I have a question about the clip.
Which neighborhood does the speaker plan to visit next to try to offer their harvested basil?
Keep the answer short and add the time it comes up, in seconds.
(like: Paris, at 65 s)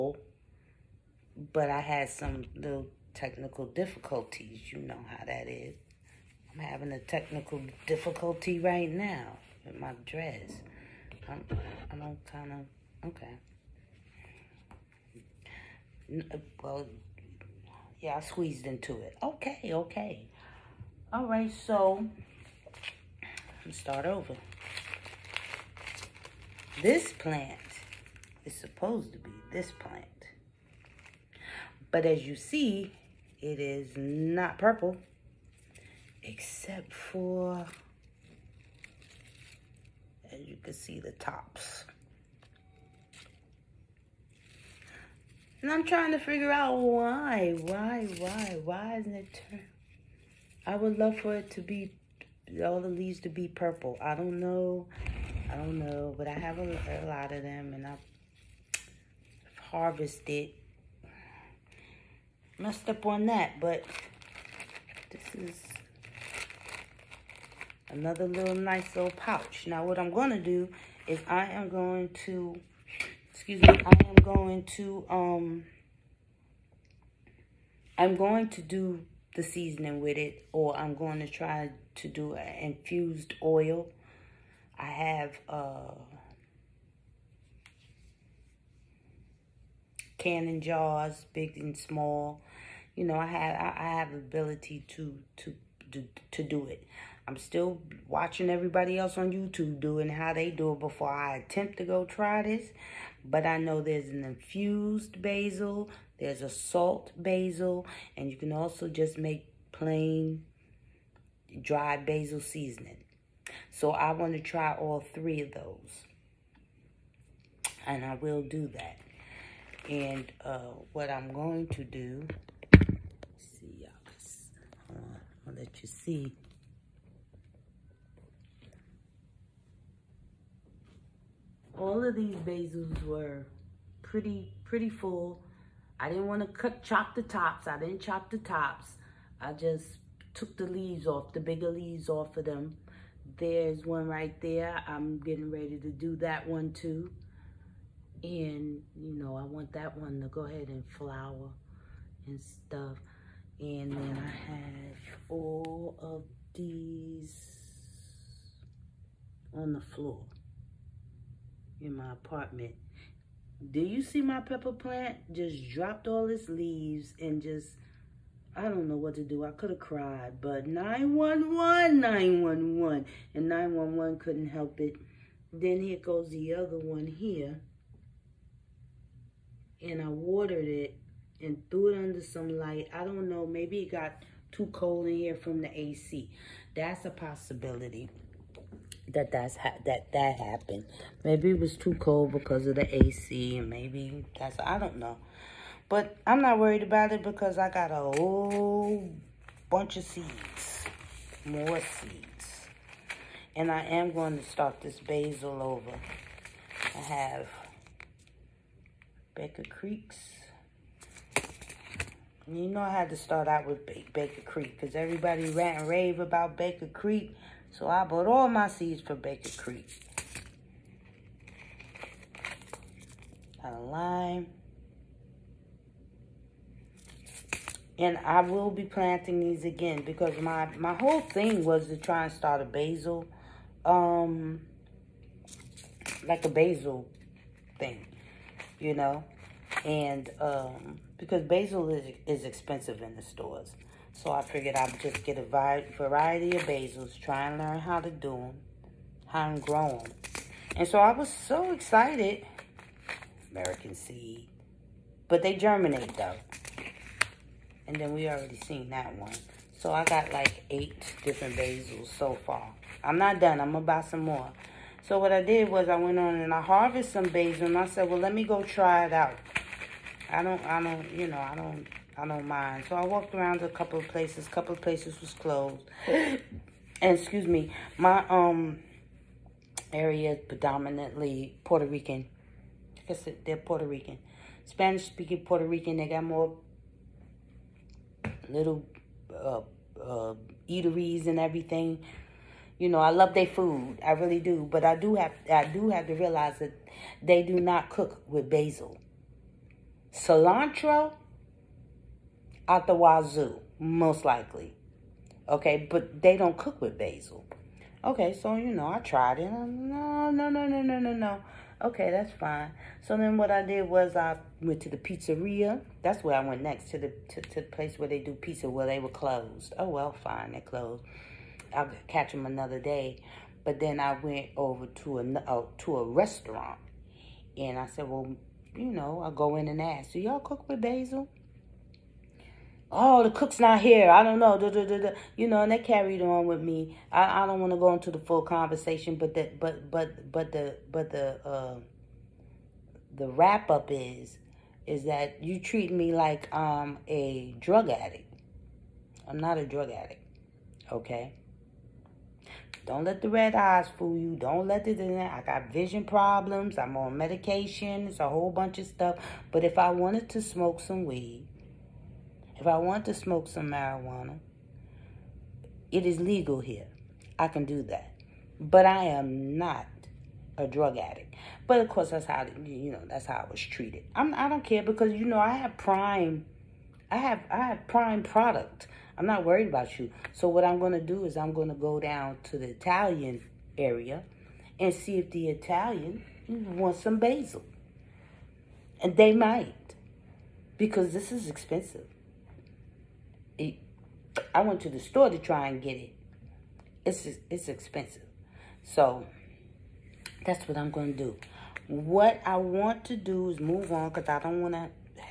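the Italian area, at 382 s.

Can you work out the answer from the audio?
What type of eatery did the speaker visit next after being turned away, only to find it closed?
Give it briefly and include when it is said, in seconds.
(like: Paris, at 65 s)
pizzeria, at 314 s.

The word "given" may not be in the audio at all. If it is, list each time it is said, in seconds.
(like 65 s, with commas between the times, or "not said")
not said.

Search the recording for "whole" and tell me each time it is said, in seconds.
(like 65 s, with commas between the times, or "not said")
198 s, 230 s, 358 s.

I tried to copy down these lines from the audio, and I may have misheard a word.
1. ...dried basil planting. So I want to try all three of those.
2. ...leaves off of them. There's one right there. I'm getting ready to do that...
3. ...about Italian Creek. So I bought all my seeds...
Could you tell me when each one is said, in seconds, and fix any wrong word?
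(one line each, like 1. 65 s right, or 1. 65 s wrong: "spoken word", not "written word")
1. 111 s wrong: "seasoning", not "planting"
2. 141 s right
3. 216 s wrong: "Baker", not "Italian".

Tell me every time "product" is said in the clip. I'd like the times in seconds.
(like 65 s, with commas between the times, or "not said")
378 s.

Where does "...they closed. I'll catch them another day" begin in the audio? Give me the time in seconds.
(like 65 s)
320 s.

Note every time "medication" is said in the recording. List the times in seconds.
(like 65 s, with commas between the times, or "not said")
357 s.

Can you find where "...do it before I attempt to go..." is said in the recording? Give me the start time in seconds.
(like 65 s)
100 s.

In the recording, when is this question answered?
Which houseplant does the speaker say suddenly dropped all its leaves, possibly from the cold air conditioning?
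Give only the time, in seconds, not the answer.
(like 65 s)
164 s.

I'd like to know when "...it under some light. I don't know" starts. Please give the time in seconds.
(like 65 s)
181 s.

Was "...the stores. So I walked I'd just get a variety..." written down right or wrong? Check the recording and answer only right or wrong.
wrong.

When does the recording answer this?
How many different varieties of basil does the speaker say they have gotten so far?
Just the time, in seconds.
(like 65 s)
260 s.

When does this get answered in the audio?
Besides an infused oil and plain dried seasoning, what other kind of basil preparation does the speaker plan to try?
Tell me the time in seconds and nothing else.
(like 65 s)
106 s.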